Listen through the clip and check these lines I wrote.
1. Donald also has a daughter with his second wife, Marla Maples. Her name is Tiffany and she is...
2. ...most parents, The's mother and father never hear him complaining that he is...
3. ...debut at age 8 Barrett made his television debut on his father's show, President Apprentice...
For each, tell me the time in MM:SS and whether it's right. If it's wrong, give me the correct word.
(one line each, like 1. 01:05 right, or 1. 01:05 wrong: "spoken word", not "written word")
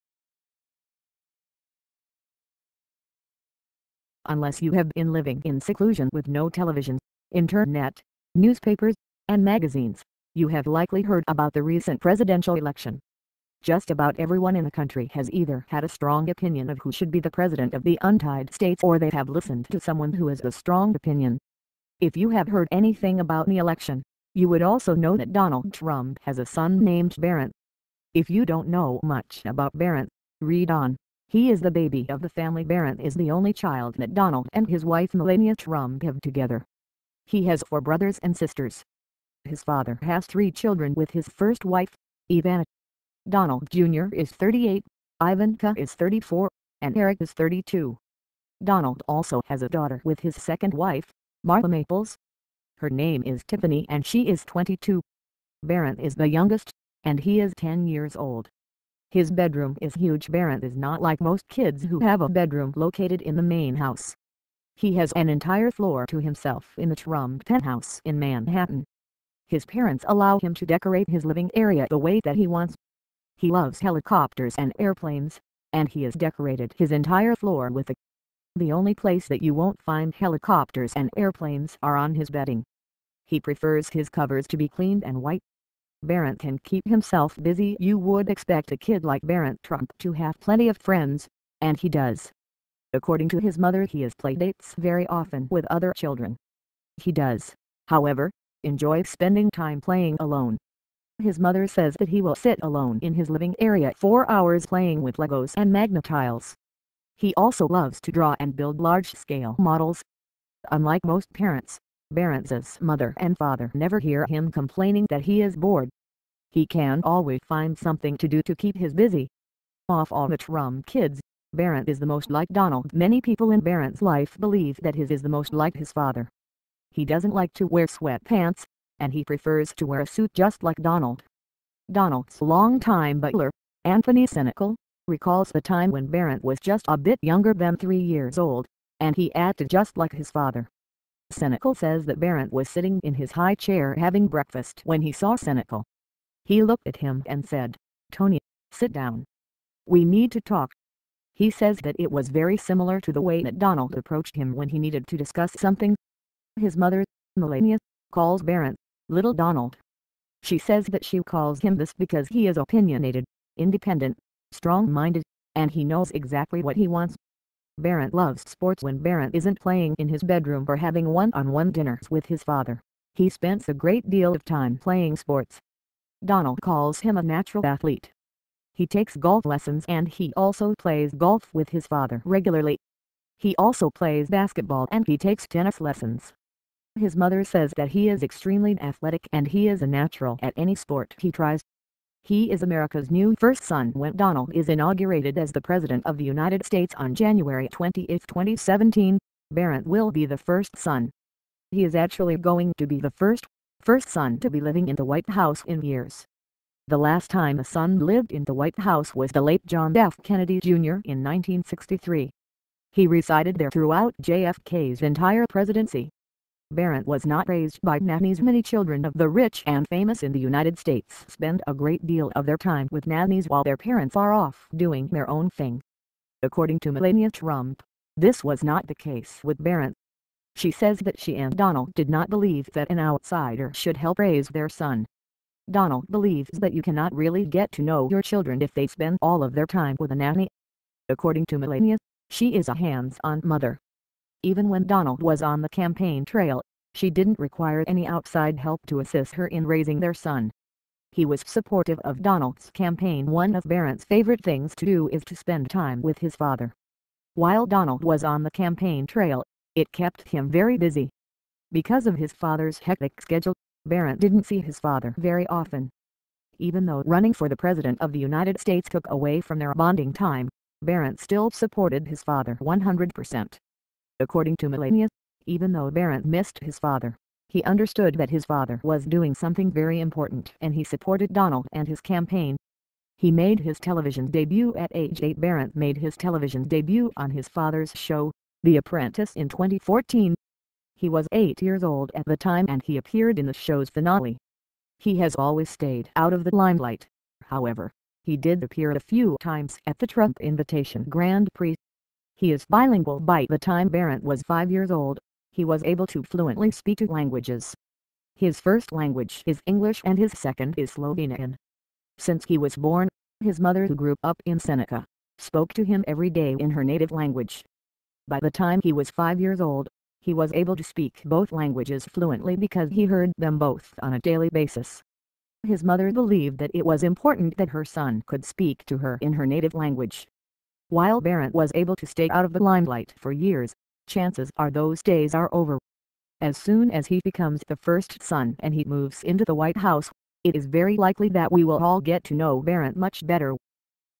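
1. 00:48 right
2. 01:51 wrong: "Baranza", not "The"
3. 04:44 wrong: "The", not "President".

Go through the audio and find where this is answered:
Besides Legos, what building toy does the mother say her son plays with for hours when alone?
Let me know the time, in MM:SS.
01:45.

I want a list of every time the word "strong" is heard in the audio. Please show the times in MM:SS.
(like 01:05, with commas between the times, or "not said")
00:15, 00:20, 02:44.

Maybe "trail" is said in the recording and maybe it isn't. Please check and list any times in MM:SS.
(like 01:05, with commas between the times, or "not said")
04:06, 04:19.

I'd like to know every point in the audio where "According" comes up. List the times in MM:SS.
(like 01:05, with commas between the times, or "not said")
01:32, 03:46, 04:01, 04:34.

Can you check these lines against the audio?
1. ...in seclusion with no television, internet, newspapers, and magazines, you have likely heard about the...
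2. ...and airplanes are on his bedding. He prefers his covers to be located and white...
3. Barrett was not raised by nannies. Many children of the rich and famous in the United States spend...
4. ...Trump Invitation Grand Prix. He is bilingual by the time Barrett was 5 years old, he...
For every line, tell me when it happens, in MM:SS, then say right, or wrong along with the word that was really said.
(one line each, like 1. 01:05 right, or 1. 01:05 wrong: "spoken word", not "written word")
1. 00:05 right
2. 01:20 wrong: "cleaned", not "located"
3. 03:36 right
4. 05:00 right.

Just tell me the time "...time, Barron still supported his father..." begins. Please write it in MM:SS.
04:30.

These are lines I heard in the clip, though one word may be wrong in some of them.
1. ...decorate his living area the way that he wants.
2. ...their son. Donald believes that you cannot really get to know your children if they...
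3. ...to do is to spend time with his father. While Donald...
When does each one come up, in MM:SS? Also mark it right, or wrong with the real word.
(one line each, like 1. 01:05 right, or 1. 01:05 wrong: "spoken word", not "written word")
1. 01:10 right
2. 03:54 right
3. 04:14 right.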